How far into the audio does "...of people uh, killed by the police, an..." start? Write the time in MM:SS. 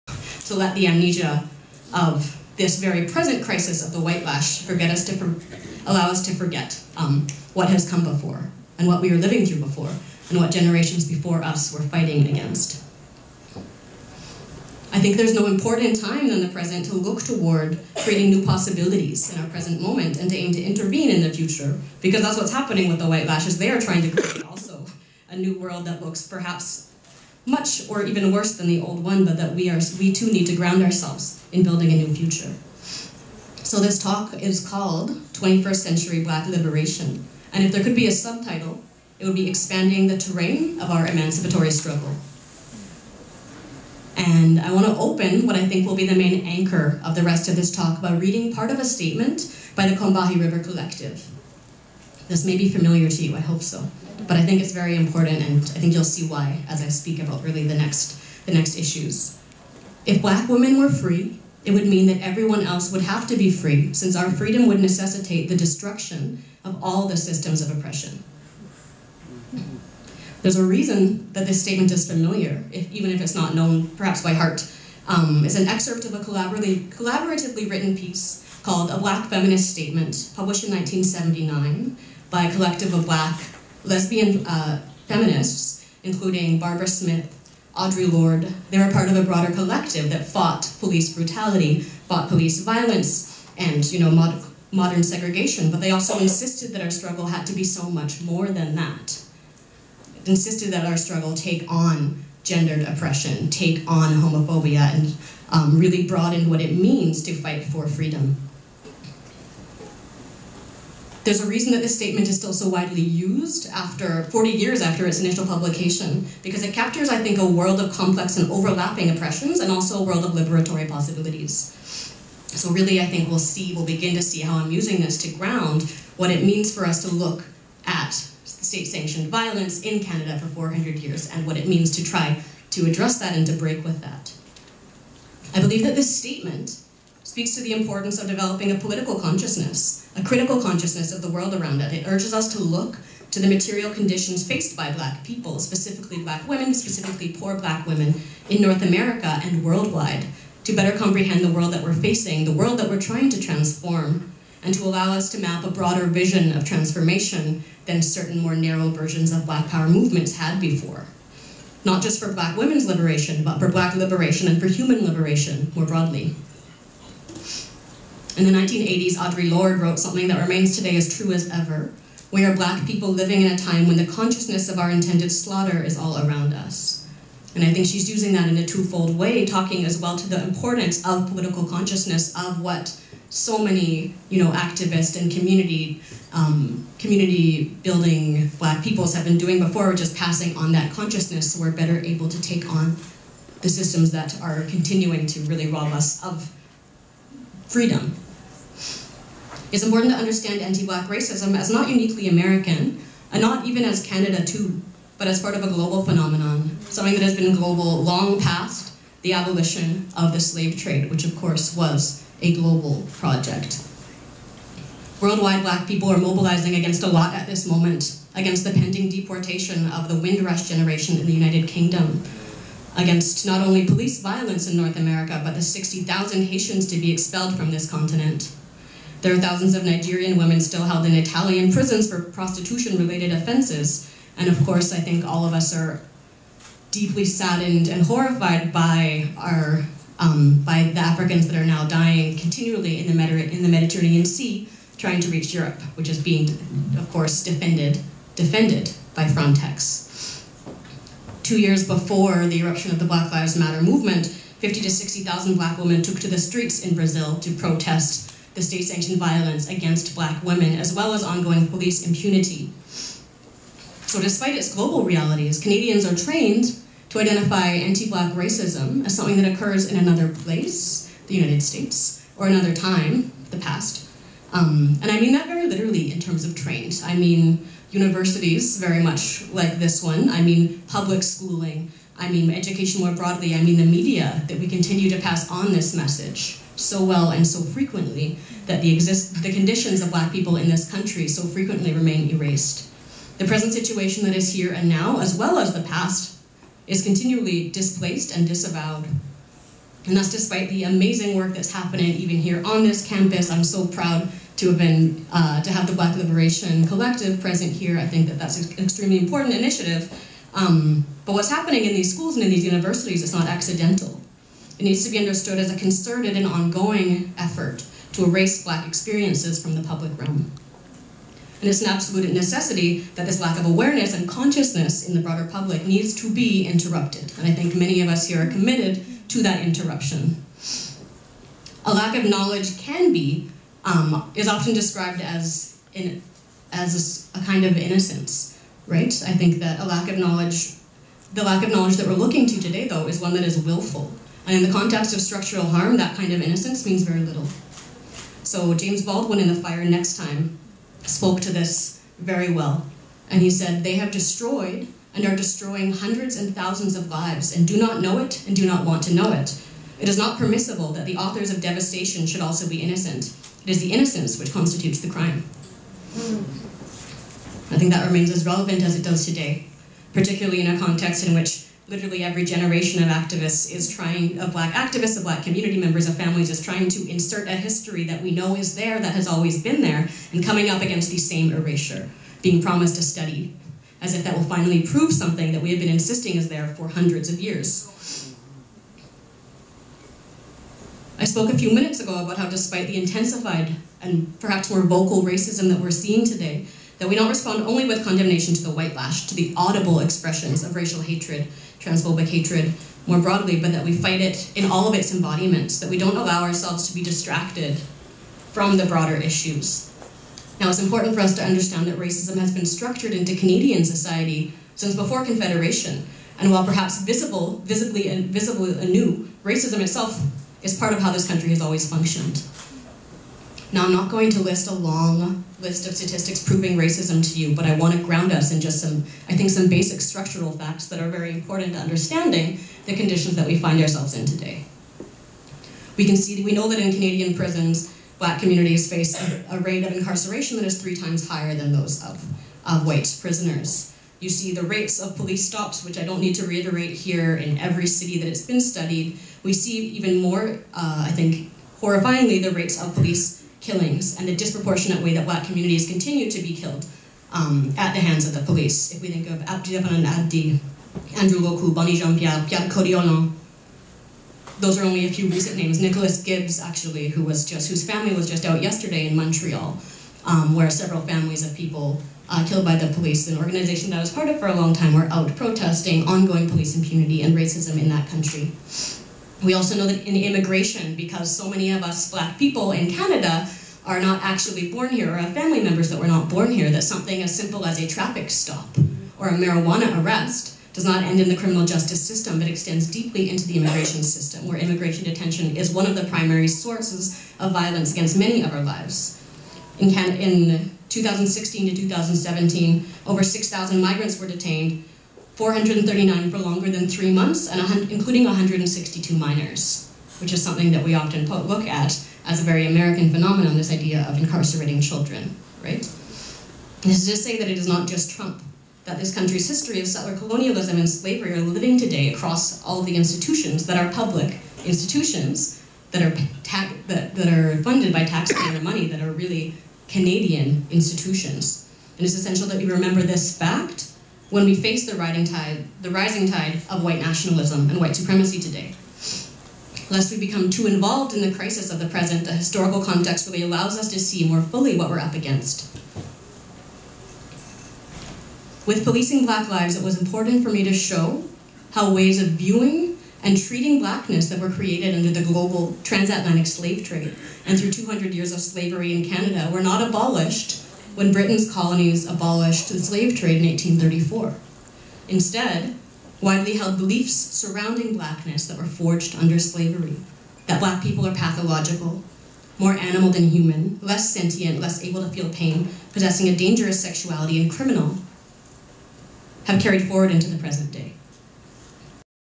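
07:51.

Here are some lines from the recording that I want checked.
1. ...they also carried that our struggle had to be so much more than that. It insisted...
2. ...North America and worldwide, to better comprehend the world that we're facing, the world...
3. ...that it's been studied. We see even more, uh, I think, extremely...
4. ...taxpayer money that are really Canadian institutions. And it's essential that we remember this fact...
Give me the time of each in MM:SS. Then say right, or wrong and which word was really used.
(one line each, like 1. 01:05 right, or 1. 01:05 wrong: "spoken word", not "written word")
1. 01:35 wrong: "insisted", not "carried"
2. 02:28 right
3. 07:28 wrong: "horrifyingly", not "extremely"
4. 08:48 right.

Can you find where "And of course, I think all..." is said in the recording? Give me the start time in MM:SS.
03:54.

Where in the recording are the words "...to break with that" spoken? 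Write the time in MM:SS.
02:13.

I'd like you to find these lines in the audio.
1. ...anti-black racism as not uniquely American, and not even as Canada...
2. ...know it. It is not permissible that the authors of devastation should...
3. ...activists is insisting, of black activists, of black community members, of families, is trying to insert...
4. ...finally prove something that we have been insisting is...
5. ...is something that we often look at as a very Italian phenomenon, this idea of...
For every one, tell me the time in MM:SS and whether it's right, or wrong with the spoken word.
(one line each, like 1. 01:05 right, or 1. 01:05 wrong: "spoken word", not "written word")
1. 03:20 right
2. 05:59 right
3. 06:13 wrong: "trying", not "insisting"
4. 06:24 right
5. 08:30 wrong: "American", not "Italian".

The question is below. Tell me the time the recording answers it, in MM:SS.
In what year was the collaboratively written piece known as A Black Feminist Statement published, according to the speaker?
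01:20.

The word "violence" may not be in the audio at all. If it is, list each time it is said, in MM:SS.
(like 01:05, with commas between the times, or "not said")
01:32, 02:09, 03:44, 04:19, 08:17.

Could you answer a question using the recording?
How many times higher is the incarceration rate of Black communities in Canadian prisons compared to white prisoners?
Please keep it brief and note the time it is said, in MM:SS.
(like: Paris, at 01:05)
3 times, at 07:20.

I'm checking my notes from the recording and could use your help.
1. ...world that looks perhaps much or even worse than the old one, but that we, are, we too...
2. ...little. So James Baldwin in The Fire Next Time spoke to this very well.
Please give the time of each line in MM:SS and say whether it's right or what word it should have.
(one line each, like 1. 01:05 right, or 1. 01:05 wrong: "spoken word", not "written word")
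1. 00:25 right
2. 05:47 right.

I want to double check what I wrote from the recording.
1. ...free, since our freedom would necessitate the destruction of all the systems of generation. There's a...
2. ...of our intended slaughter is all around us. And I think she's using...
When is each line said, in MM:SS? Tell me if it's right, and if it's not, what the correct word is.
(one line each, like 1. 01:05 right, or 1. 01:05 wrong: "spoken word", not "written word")
1. 01:03 wrong: "oppression", not "generation"
2. 02:54 right.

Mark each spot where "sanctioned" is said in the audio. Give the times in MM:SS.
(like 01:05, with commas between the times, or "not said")
02:08, 04:18.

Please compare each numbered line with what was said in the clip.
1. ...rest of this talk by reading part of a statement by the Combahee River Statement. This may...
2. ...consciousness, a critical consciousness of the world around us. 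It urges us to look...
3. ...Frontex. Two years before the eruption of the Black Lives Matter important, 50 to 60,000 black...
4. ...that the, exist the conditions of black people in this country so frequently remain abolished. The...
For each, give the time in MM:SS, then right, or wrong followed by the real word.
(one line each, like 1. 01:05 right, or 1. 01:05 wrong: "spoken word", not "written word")
1. 00:47 wrong: "Collective", not "Statement"
2. 02:19 right
3. 04:09 wrong: "movement", not "important"
4. 04:48 wrong: "erased", not "abolished".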